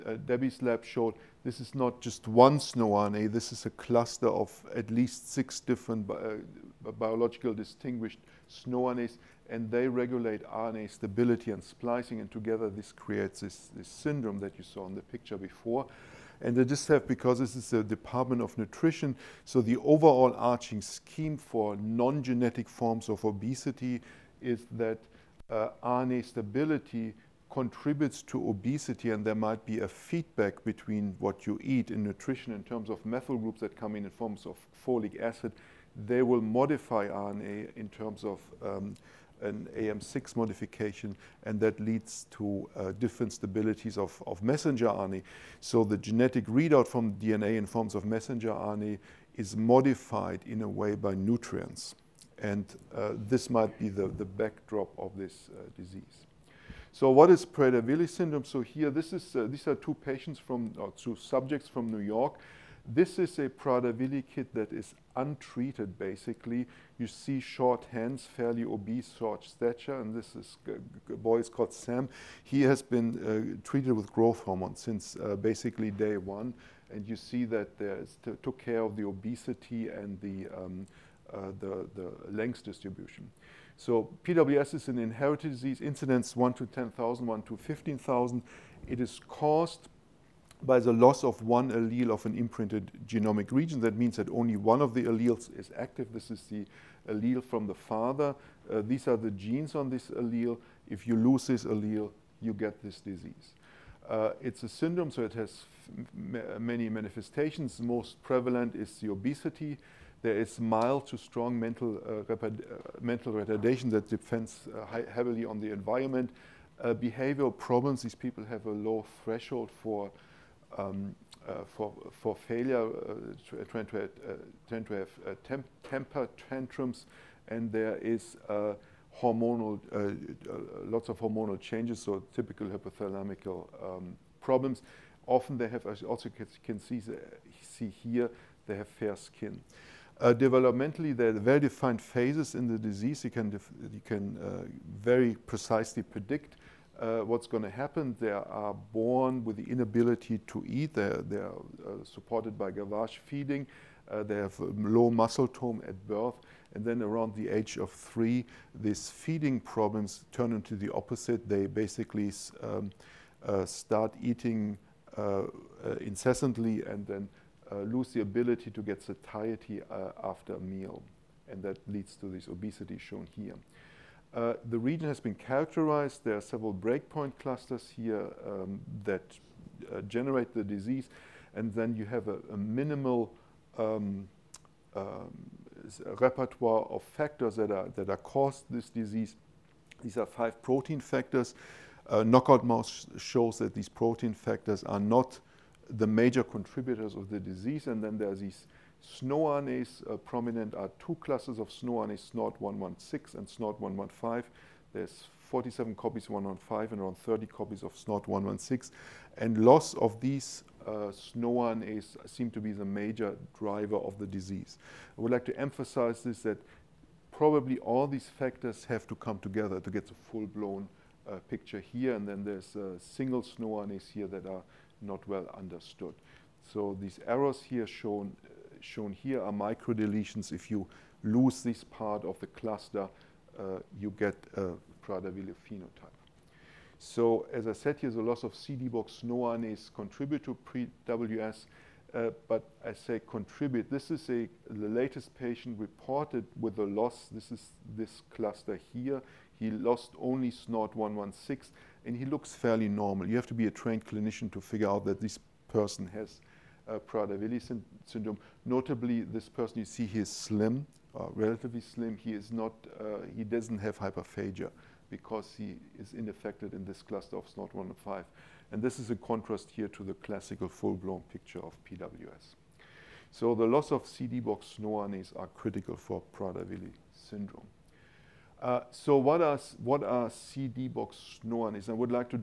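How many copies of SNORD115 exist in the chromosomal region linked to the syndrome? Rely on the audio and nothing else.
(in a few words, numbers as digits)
47.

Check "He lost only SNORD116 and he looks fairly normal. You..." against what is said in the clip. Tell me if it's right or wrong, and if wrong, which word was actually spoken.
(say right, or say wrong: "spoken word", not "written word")
right.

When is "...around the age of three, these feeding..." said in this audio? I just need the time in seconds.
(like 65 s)
157 s.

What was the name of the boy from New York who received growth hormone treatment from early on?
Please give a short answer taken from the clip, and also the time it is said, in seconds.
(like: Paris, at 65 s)
Sam, at 71 s.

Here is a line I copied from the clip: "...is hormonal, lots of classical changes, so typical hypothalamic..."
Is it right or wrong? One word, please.
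wrong.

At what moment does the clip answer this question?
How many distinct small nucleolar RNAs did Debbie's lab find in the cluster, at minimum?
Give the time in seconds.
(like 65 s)
5 s.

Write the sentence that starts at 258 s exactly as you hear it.
Notably, this person you see he is slim, uh, relatively slim.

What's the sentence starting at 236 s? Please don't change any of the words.
So as I said here, the loss of CD-box No is contribute to pre-WS, uh, but I say contribute.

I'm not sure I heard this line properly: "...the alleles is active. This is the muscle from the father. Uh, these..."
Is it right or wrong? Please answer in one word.
wrong.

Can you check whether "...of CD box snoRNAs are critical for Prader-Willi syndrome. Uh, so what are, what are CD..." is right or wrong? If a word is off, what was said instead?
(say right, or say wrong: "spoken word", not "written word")
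right.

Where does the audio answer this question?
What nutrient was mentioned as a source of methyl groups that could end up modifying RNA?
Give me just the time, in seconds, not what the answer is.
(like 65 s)
34 s.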